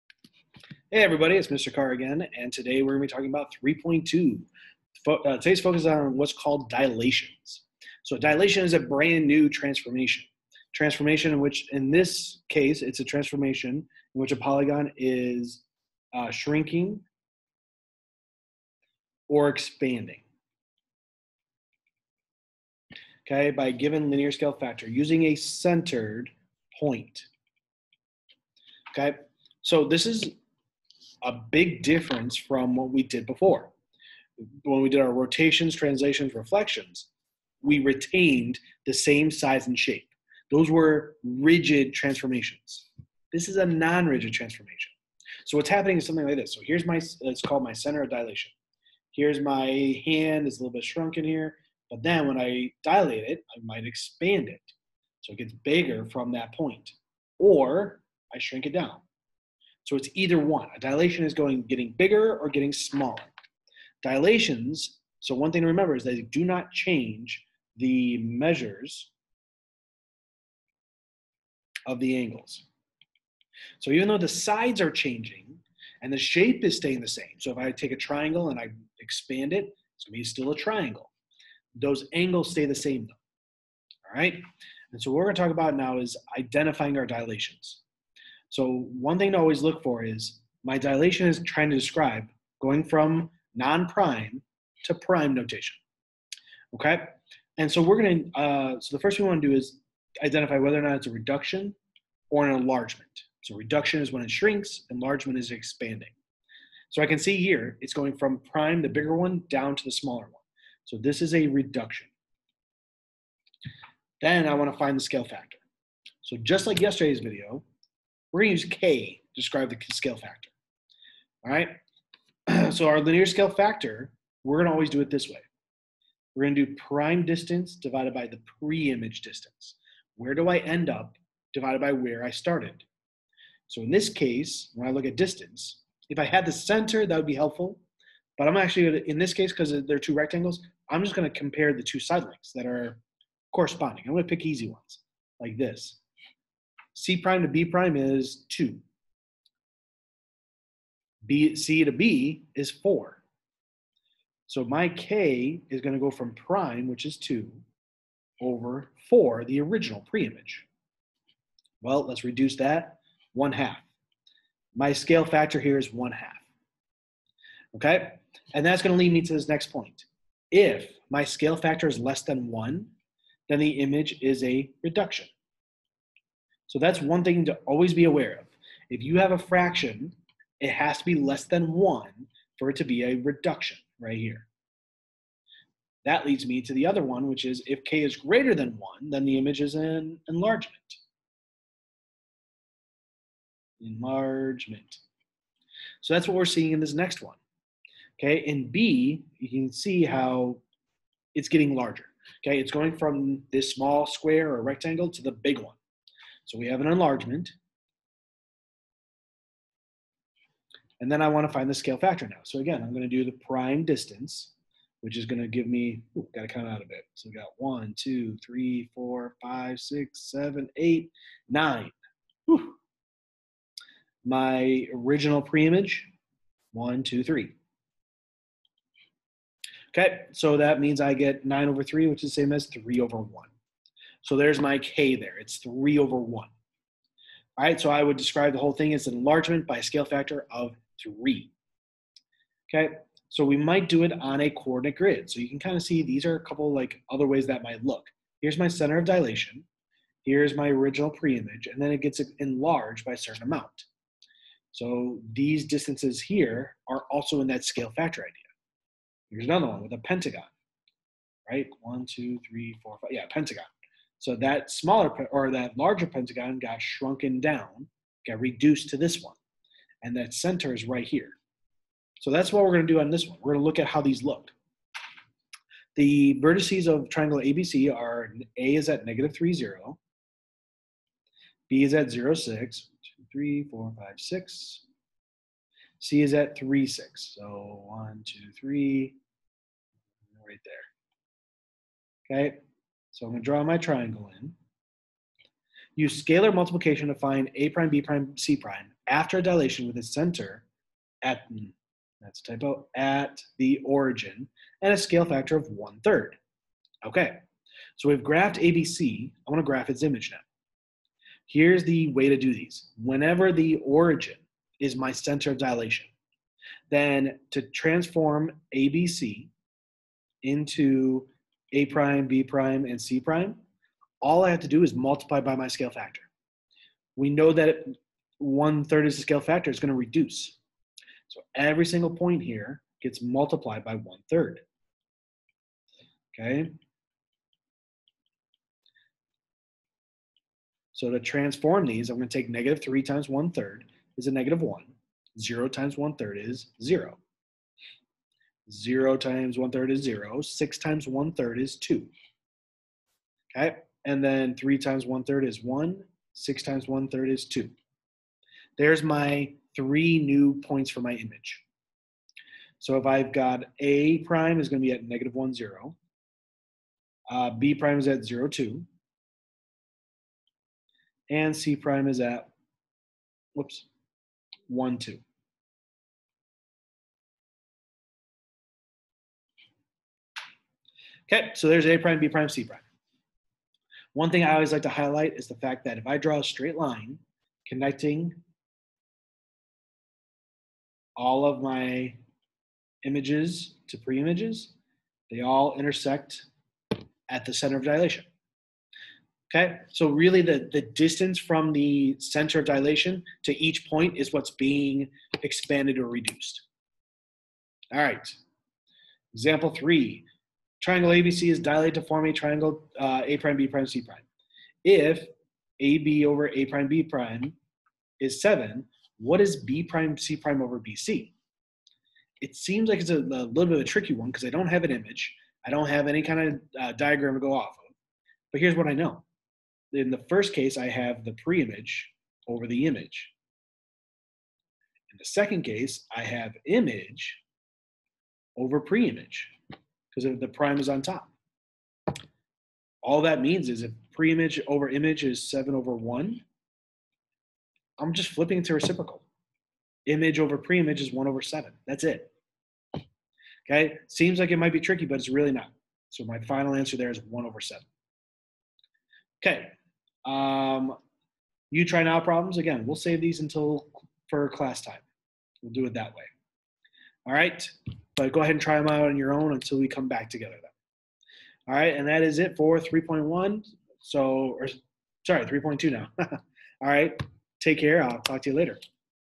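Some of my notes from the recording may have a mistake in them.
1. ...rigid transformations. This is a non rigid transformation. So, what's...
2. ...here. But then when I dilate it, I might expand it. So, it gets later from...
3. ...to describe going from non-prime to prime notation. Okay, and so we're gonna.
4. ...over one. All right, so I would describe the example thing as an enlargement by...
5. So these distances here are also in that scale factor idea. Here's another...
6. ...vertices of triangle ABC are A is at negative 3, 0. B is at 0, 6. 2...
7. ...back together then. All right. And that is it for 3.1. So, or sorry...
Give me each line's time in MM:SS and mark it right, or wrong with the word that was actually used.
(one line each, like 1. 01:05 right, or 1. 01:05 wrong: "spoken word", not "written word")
1. 00:41 right
2. 00:51 wrong: "bigger", not "later"
3. 01:31 right
4. 03:55 wrong: "whole", not "example"
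5. 04:14 right
6. 04:36 right
7. 07:50 right.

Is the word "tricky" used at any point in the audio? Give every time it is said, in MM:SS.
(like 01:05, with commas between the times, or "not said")
07:03, 07:34.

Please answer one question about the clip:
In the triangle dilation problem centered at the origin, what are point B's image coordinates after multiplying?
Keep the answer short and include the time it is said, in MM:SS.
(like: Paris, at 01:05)
(0, 2), at 06:08.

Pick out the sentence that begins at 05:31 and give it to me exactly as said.
So every single point here gets multiplied by one third.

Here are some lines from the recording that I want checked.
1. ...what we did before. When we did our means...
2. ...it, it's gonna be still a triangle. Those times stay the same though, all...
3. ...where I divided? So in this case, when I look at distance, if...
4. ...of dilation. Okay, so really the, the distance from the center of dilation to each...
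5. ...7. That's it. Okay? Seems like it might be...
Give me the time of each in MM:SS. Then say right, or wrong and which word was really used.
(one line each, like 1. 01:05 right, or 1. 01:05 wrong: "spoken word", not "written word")
1. 00:32 wrong: "rotations", not "means"
2. 01:19 wrong: "angles", not "times"
3. 02:11 wrong: "started", not "divided"
4. 06:37 right
5. 07:31 right.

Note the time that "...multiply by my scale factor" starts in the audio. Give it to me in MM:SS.
05:24.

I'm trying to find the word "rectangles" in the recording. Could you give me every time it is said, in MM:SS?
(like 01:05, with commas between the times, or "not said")
02:20, 03:24.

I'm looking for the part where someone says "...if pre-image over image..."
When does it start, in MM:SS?
07:23.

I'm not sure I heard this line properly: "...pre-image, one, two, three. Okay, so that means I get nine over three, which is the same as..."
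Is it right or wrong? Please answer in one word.
right.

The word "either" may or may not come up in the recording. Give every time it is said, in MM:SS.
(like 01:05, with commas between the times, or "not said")
01:00.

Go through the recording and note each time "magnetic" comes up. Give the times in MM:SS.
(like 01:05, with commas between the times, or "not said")
not said.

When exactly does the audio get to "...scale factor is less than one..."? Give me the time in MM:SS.
02:51.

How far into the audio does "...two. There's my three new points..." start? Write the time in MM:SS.
05:57.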